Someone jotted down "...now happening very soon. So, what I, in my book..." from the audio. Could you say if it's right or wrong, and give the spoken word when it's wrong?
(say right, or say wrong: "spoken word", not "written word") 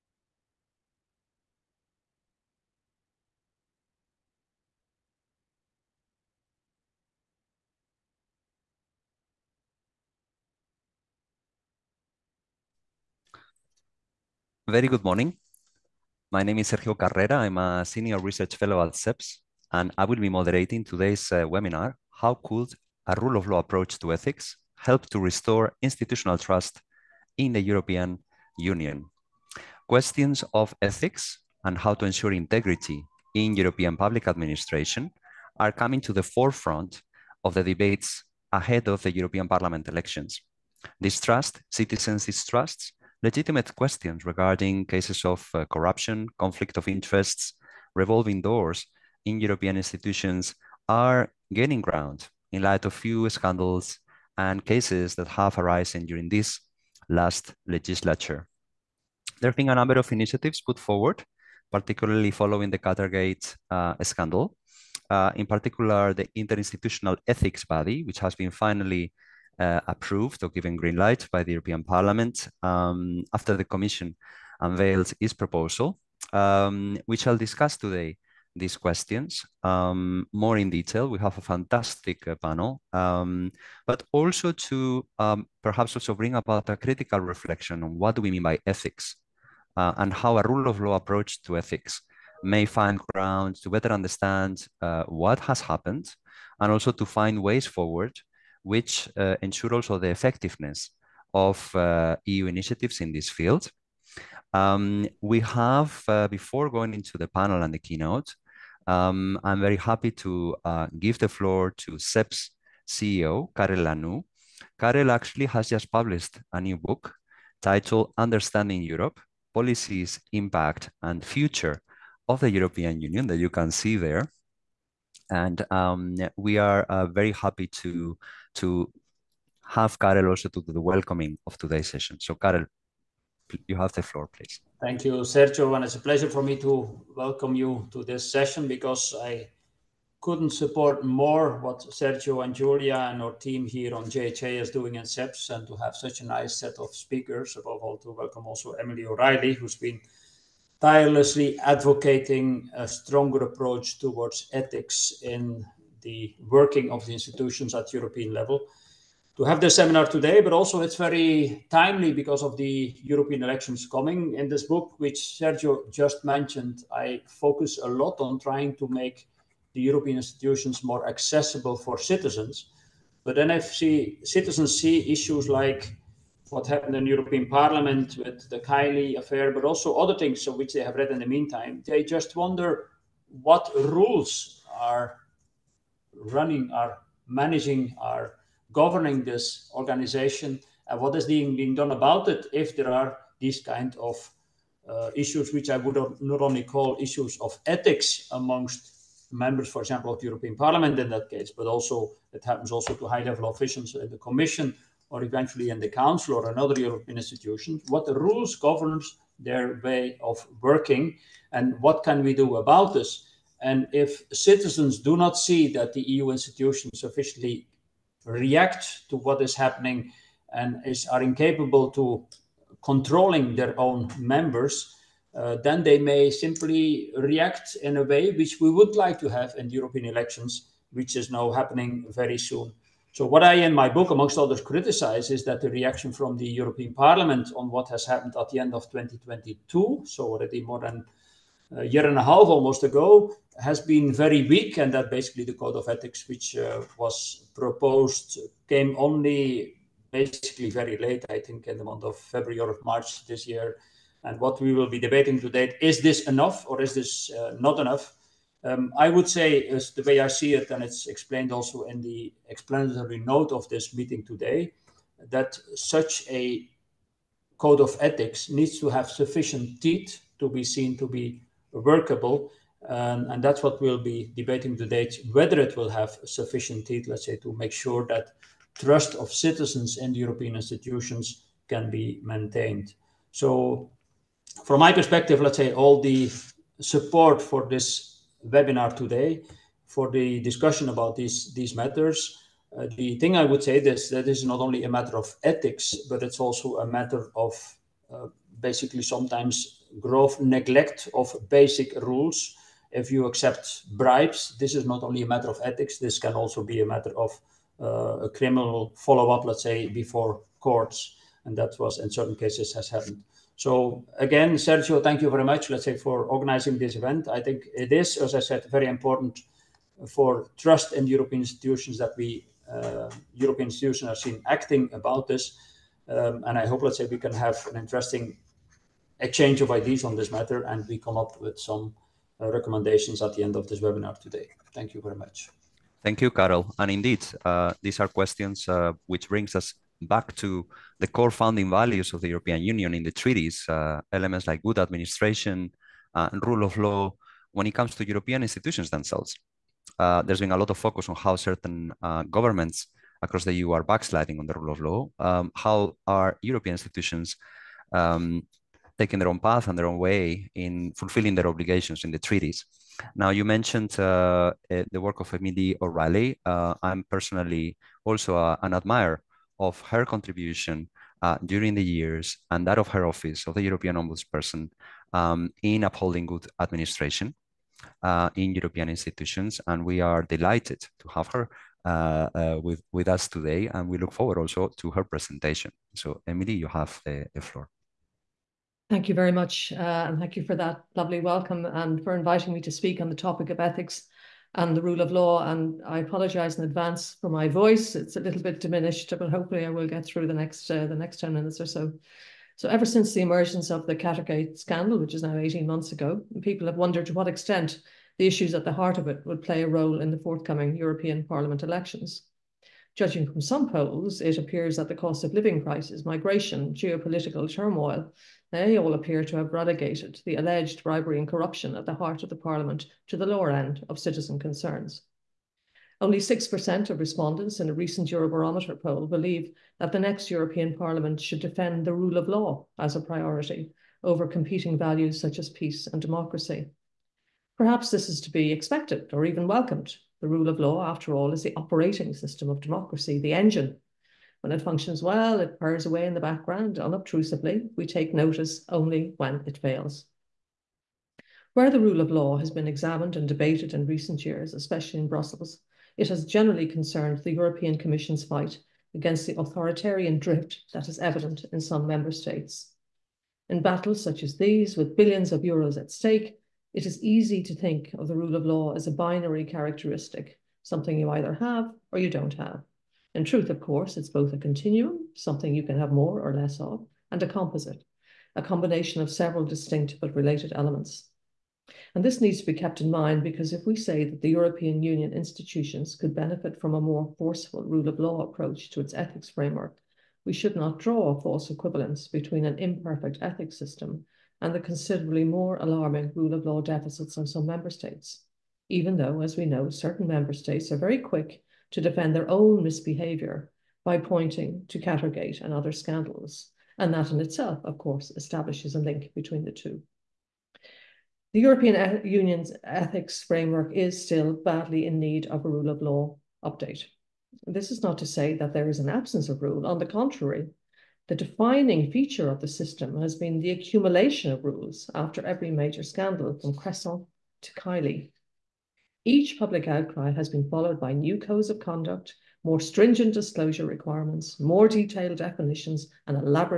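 right.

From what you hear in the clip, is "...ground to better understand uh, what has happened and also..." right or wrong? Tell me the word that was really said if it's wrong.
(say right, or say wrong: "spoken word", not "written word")
right.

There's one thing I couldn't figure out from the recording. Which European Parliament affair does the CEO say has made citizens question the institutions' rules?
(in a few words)
Kaili affair.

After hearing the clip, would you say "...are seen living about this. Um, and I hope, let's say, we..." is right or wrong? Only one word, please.
wrong.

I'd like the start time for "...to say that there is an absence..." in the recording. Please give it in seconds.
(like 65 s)
517 s.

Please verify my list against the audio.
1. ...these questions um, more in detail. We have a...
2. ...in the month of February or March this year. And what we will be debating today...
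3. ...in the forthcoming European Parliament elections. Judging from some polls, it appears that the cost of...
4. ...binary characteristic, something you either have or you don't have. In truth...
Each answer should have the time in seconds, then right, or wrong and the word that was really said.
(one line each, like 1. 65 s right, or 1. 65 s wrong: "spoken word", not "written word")
1. 78 s right
2. 251 s right
3. 409 s right
4. 468 s right.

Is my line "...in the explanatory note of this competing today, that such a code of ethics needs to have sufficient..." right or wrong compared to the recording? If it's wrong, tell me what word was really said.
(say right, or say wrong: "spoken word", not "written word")
wrong: "meeting", not "competing".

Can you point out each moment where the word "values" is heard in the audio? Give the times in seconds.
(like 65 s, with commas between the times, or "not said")
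341 s, 434 s.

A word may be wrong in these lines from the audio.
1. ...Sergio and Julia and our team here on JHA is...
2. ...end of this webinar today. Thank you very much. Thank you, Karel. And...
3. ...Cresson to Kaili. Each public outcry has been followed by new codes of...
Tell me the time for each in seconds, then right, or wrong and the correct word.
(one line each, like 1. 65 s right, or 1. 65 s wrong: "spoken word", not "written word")
1. 141 s right
2. 333 s right
3. 526 s right.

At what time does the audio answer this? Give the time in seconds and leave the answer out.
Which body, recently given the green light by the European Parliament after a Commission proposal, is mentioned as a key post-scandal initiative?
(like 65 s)
66 s.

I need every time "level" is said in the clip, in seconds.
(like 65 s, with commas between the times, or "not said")
158 s, 203 s.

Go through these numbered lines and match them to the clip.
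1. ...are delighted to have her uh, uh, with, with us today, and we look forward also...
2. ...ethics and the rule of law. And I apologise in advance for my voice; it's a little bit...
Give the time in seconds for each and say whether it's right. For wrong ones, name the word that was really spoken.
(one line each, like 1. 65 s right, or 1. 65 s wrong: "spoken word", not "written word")
1. 379 s right
2. 393 s right.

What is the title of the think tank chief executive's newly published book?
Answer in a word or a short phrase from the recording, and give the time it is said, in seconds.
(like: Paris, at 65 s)
Understanding Europe, at 118 s.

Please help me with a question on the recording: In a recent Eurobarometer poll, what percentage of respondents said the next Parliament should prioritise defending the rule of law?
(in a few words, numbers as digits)
6%.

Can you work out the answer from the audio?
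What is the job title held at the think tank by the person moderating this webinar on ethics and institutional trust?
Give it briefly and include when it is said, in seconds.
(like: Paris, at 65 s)
Senior Research Fellow, at 17 s.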